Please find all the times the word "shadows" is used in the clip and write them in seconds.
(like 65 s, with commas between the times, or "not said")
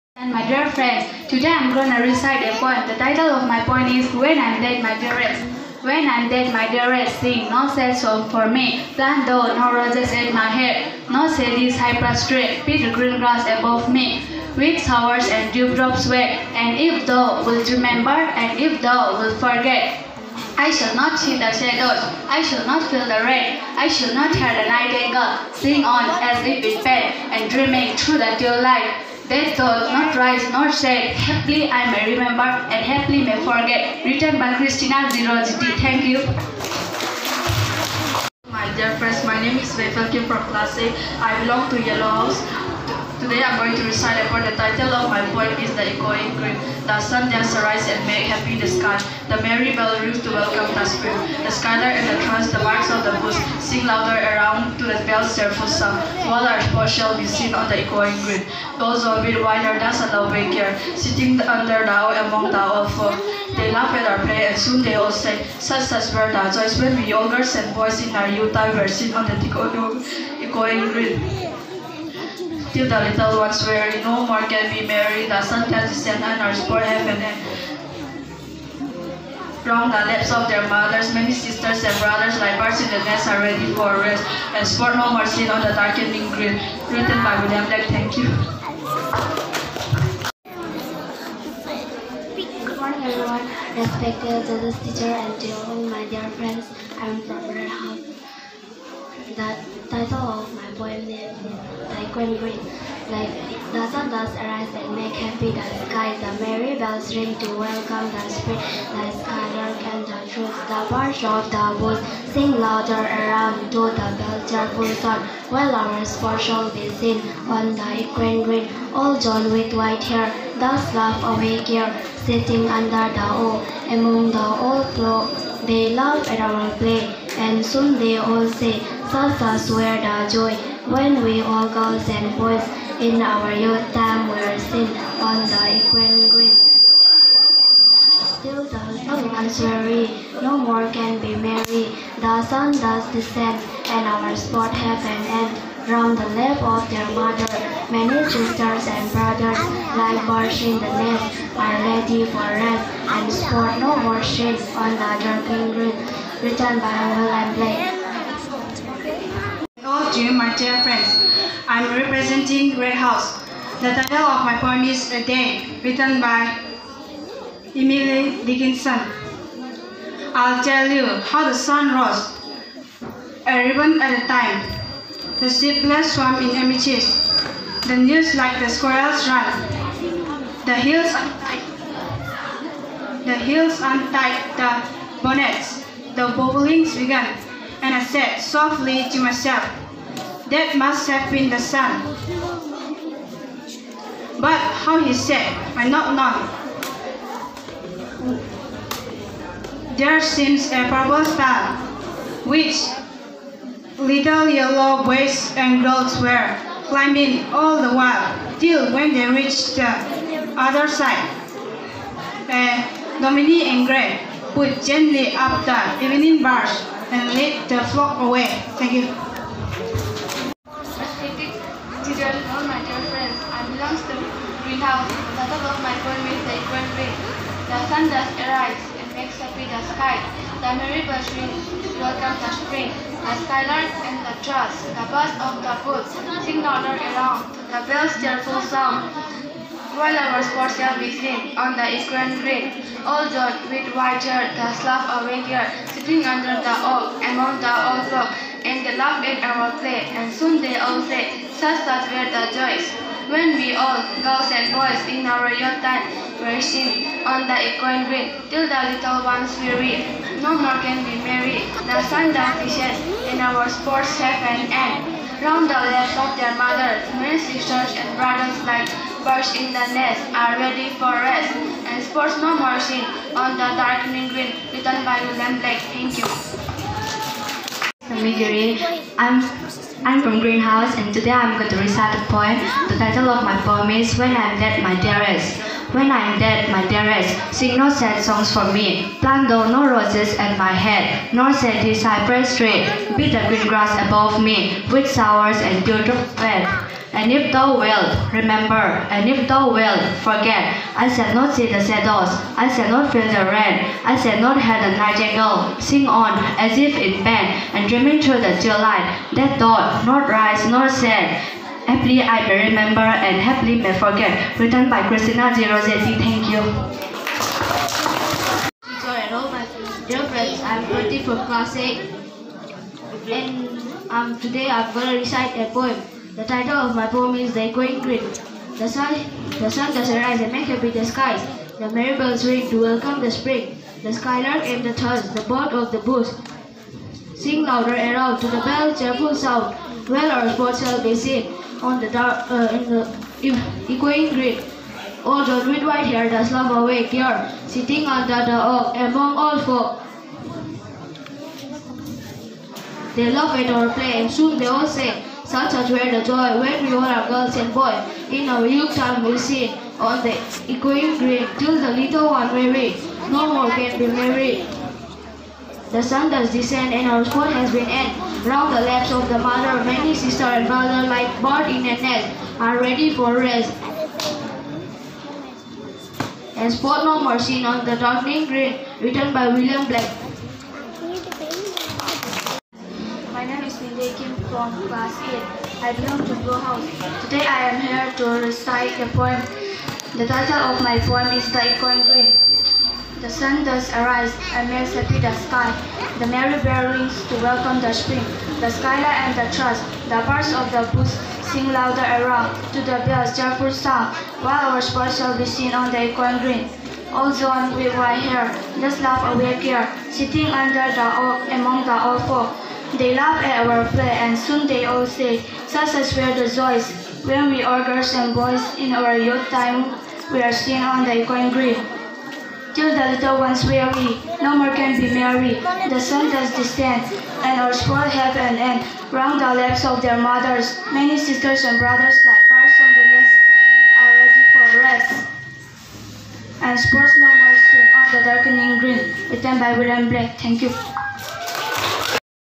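21 s, 301 s.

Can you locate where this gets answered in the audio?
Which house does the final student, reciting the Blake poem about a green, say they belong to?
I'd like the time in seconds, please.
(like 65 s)
386 s.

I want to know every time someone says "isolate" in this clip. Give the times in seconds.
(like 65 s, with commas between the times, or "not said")
not said.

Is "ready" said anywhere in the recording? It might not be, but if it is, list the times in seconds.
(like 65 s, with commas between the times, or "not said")
83 s, 151 s, 270 s, 320 s, 372 s, 434 s.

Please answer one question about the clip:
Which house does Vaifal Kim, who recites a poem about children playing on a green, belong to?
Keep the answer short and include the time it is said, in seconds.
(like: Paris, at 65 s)
Yellow House, at 41 s.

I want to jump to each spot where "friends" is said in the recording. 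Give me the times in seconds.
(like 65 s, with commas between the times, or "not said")
0 s, 38 s, 96 s, 160 s, 223 s, 320 s.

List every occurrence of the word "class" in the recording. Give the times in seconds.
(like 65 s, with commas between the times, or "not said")
40 s, 321 s.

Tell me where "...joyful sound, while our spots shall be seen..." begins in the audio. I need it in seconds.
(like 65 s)
403 s.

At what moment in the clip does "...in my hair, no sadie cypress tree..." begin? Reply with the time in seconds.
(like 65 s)
10 s.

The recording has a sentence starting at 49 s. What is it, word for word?
The merry bell rings to welcome the spring.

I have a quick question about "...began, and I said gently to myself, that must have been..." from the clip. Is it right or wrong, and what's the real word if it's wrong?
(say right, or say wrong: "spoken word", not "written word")
wrong: "softly", not "gently".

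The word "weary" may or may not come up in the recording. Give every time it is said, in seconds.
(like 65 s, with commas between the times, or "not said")
139 s, 259 s, 362 s, 423 s.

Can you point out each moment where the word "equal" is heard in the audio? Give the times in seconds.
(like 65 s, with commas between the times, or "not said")
226 s.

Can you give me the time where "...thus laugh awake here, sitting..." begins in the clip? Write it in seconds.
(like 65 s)
120 s.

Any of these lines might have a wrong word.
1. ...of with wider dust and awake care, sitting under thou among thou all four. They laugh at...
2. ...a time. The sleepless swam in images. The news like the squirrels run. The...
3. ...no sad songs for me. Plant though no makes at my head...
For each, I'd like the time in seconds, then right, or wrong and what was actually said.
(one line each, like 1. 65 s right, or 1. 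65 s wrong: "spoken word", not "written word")
1. 59 s right
2. 174 s right
3. 287 s wrong: "roses", not "makes".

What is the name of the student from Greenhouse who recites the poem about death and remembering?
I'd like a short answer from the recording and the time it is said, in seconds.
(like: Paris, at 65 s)
Migiri, at 278 s.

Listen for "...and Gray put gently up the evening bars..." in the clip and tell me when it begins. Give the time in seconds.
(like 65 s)
213 s.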